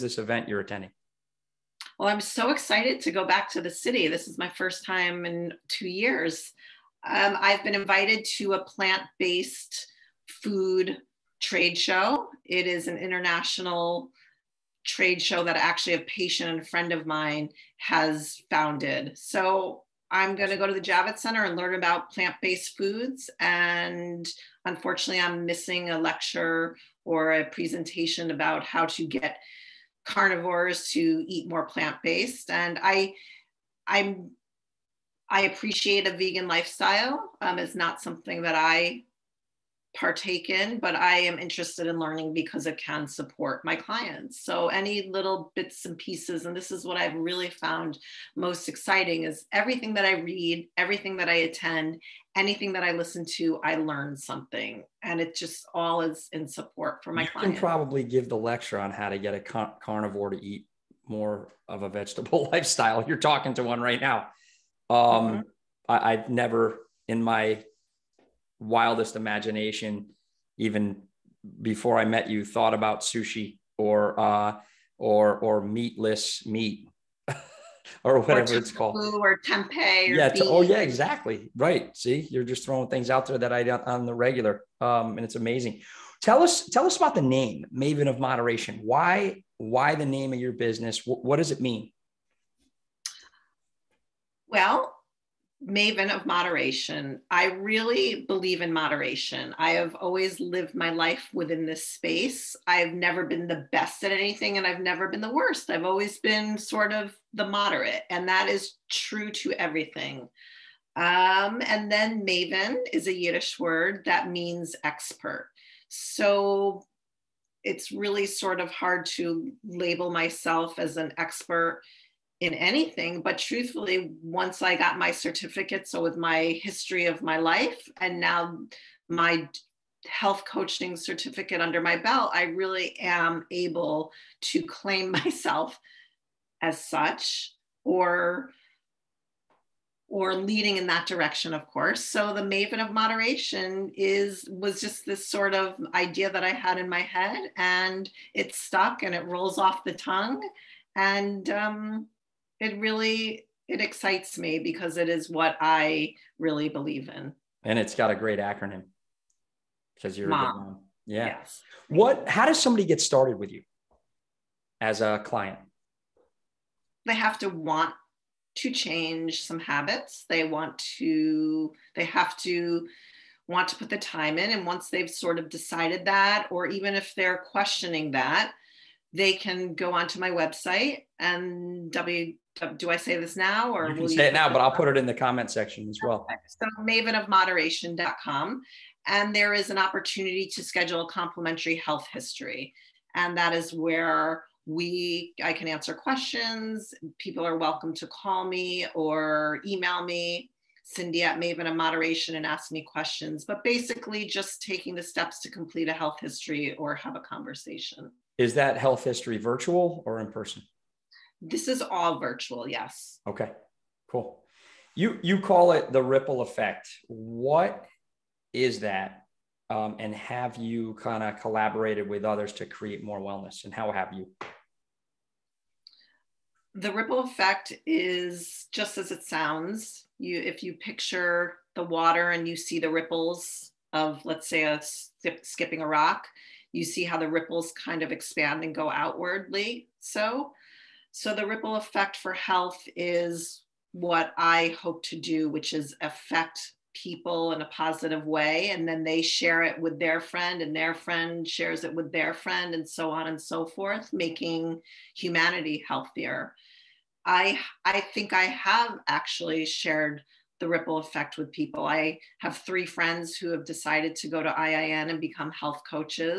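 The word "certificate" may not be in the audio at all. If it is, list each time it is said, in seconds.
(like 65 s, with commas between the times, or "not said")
125 s, 130 s.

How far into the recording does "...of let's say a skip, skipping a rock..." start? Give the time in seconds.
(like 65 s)
233 s.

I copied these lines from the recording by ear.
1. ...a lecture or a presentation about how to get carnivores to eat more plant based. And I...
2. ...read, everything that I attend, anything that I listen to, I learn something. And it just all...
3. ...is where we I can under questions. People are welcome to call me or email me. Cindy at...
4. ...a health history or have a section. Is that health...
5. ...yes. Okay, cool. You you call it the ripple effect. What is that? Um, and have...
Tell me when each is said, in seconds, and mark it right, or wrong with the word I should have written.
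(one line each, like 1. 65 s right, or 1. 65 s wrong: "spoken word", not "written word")
1. 25 s right
2. 50 s right
3. 193 s wrong: "answer", not "under"
4. 205 s wrong: "conversation", not "section"
5. 212 s right.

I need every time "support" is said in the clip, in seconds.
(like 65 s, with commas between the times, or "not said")
43 s, 56 s.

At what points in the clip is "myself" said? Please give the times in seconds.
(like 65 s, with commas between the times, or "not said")
120 s, 135 s.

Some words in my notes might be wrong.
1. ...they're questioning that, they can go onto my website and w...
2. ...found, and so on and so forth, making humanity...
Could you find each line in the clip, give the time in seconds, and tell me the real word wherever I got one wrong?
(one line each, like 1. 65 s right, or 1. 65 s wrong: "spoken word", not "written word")
1. 177 s right
2. 252 s wrong: "friend", not "found".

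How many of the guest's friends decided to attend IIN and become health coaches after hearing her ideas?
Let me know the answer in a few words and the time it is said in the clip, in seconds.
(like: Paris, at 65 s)
3, at 262 s.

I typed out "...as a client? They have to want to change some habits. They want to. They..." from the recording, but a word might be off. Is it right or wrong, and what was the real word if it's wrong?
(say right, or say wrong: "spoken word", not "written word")
right.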